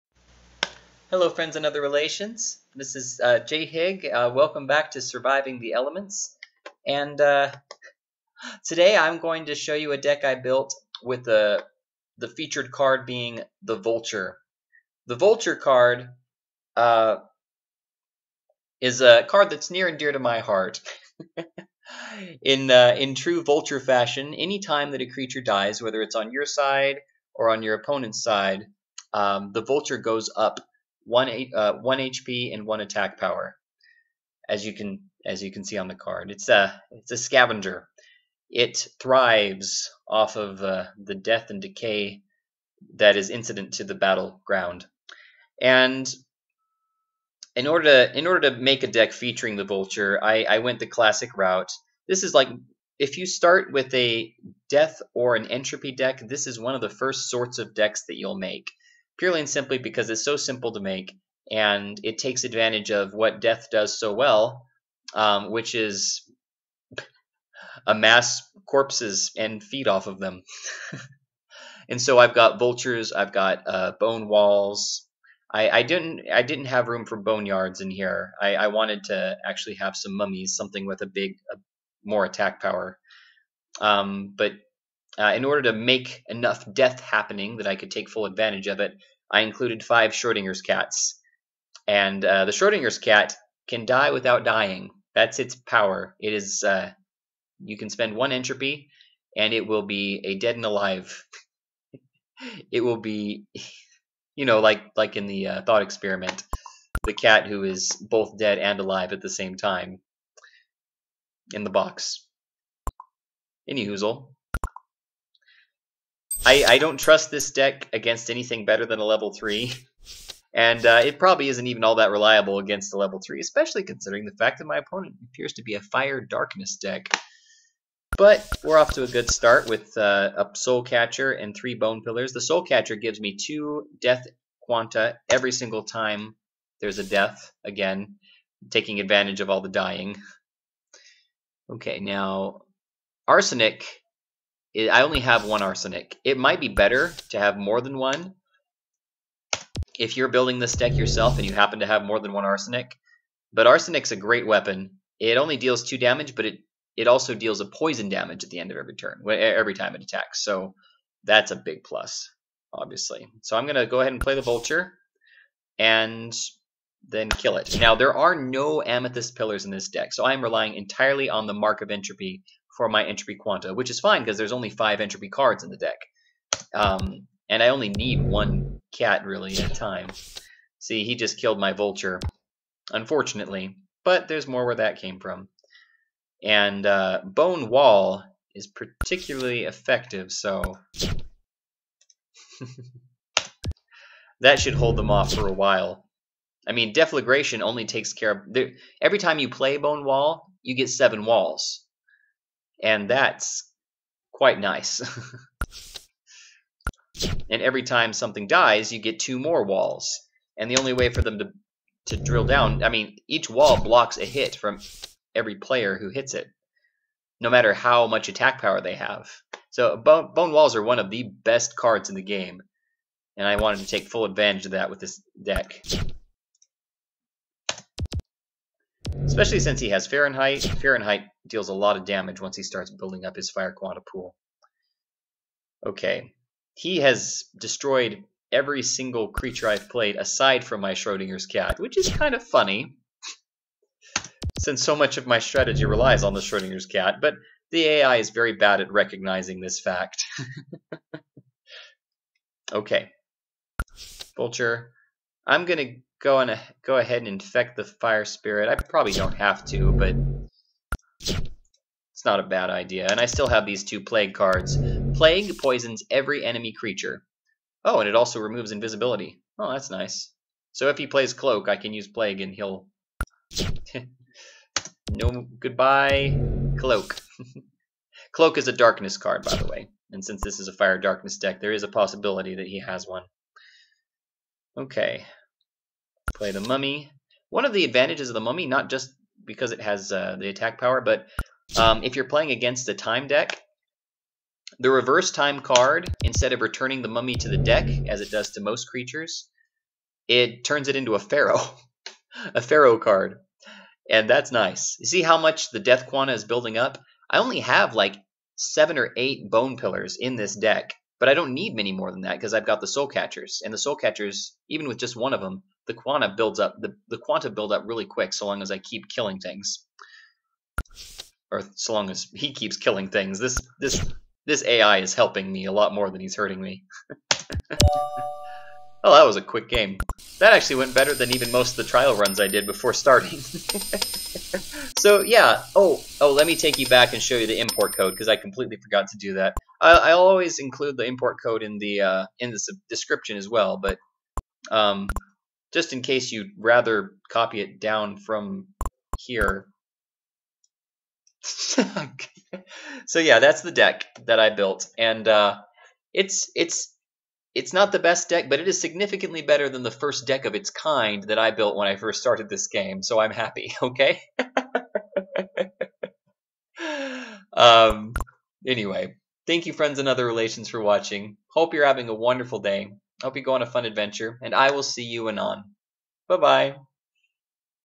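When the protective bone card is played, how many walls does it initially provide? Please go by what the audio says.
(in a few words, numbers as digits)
7.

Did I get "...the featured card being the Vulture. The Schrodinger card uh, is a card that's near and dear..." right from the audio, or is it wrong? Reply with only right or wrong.
wrong.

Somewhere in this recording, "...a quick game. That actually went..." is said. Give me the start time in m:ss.
5:29.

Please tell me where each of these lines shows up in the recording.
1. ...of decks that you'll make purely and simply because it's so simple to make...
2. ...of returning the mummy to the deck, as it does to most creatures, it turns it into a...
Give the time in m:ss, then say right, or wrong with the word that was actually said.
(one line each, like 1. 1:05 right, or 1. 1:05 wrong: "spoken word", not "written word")
1. 0:57 right
2. 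4:56 right.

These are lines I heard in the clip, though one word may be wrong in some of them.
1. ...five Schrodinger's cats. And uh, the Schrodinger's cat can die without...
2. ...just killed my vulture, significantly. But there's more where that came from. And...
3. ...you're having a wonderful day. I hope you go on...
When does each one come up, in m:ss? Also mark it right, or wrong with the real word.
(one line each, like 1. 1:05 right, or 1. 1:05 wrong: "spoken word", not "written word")
1. 1:29 right
2. 3:01 wrong: "unfortunately", not "significantly"
3. 6:11 right.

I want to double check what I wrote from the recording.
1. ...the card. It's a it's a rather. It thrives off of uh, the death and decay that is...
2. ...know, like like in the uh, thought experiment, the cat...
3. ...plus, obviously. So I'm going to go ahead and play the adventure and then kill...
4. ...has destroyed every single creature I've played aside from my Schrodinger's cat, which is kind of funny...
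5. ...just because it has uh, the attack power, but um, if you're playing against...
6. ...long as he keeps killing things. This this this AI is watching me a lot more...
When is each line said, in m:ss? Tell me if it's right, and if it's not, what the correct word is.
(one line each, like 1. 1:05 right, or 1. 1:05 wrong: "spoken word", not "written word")
1. 0:35 wrong: "scavenger", not "rather"
2. 1:44 right
3. 2:41 wrong: "vulture", not "adventure"
4. 3:56 right
5. 4:48 right
6. 5:21 wrong: "helping", not "watching".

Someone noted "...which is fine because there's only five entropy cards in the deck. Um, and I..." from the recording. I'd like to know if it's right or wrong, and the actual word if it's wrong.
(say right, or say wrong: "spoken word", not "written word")
right.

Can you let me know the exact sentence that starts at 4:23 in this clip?
And I still have these two plague cards.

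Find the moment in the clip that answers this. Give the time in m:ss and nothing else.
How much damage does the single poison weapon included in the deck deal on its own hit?
2:35.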